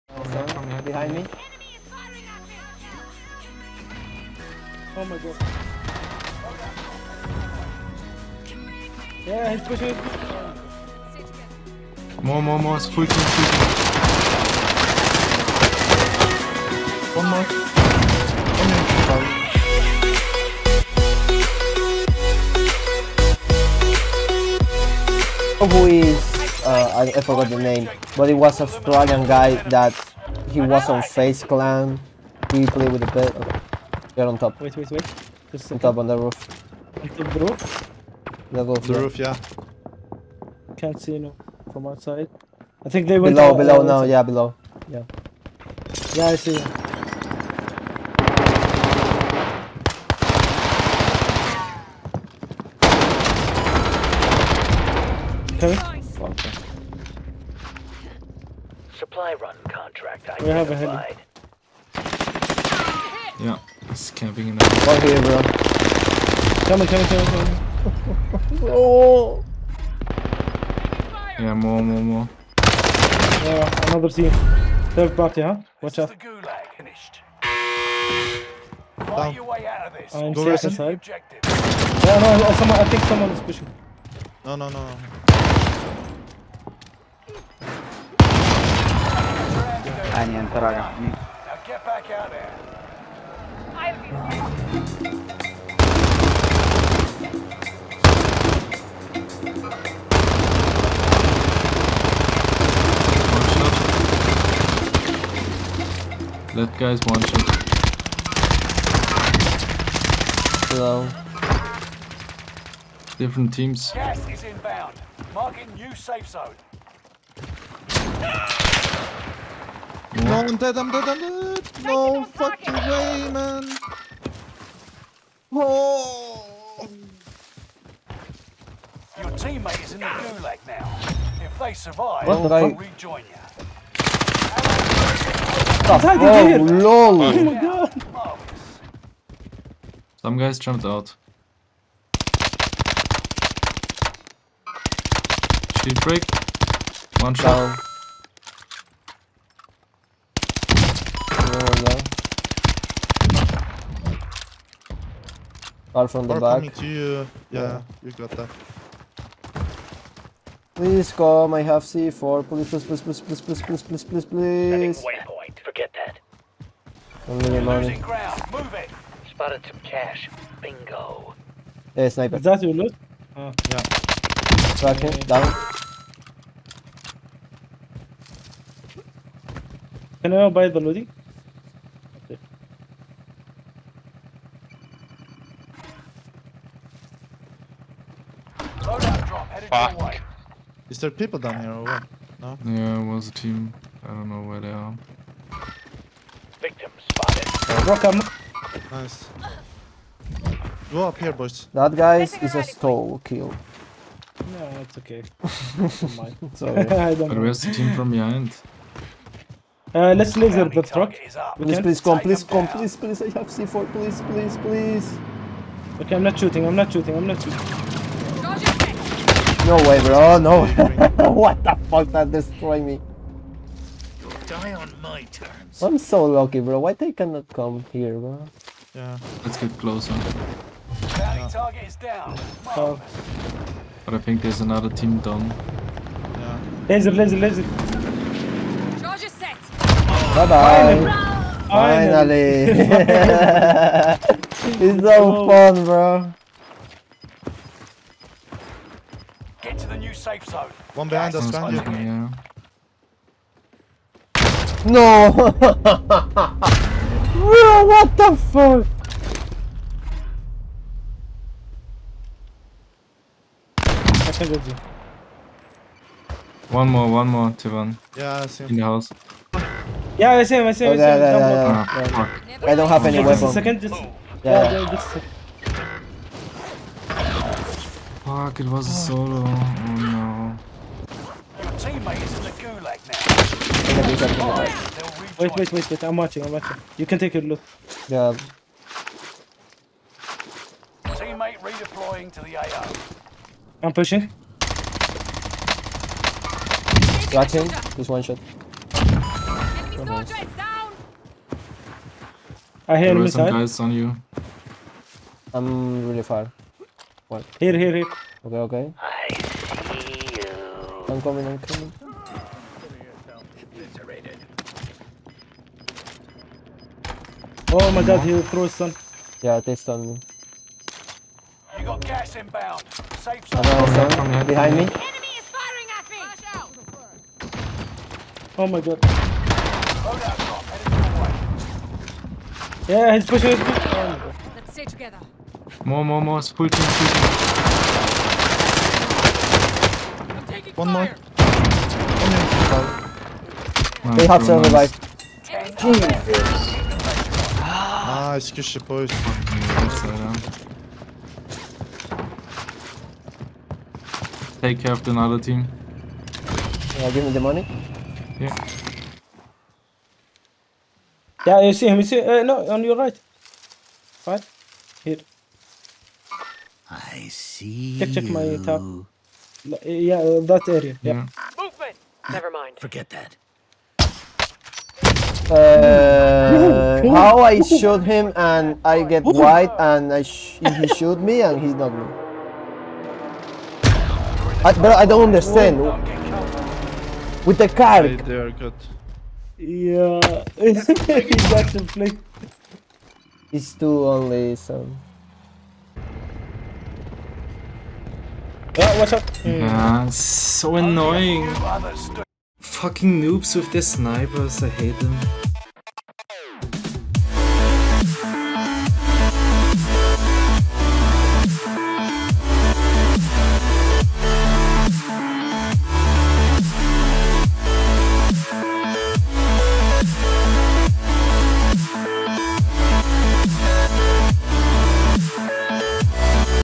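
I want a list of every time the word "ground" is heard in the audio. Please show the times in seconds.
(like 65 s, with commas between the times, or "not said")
168 s.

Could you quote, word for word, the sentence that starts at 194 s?
I don't know where they are.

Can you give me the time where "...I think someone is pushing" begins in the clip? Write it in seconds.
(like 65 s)
82 s.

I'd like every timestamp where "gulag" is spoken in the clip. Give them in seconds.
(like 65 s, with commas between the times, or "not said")
130 s.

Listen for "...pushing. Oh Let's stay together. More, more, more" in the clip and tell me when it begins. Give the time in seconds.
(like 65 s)
333 s.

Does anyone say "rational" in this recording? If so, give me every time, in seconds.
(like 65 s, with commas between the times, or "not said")
not said.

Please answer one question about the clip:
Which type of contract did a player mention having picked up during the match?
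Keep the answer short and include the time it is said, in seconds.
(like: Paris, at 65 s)
Supply run, at 58 s.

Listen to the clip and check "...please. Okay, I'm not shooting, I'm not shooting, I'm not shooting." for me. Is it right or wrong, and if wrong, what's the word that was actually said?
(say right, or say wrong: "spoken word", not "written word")
right.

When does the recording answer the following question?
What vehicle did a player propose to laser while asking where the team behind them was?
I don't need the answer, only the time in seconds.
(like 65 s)
210 s.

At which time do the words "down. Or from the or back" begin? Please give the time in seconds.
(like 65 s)
151 s.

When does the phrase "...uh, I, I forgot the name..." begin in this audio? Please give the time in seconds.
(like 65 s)
26 s.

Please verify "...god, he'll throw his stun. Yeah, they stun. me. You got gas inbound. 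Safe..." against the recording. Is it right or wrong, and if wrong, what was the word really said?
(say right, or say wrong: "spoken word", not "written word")
right.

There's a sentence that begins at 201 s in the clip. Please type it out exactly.
That guy is a stall kill.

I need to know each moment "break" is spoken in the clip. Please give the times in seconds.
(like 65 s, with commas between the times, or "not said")
146 s.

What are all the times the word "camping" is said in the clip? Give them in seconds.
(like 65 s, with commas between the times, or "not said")
64 s.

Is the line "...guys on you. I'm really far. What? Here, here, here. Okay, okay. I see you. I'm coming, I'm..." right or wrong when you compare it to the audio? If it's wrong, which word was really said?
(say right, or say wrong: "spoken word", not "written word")
right.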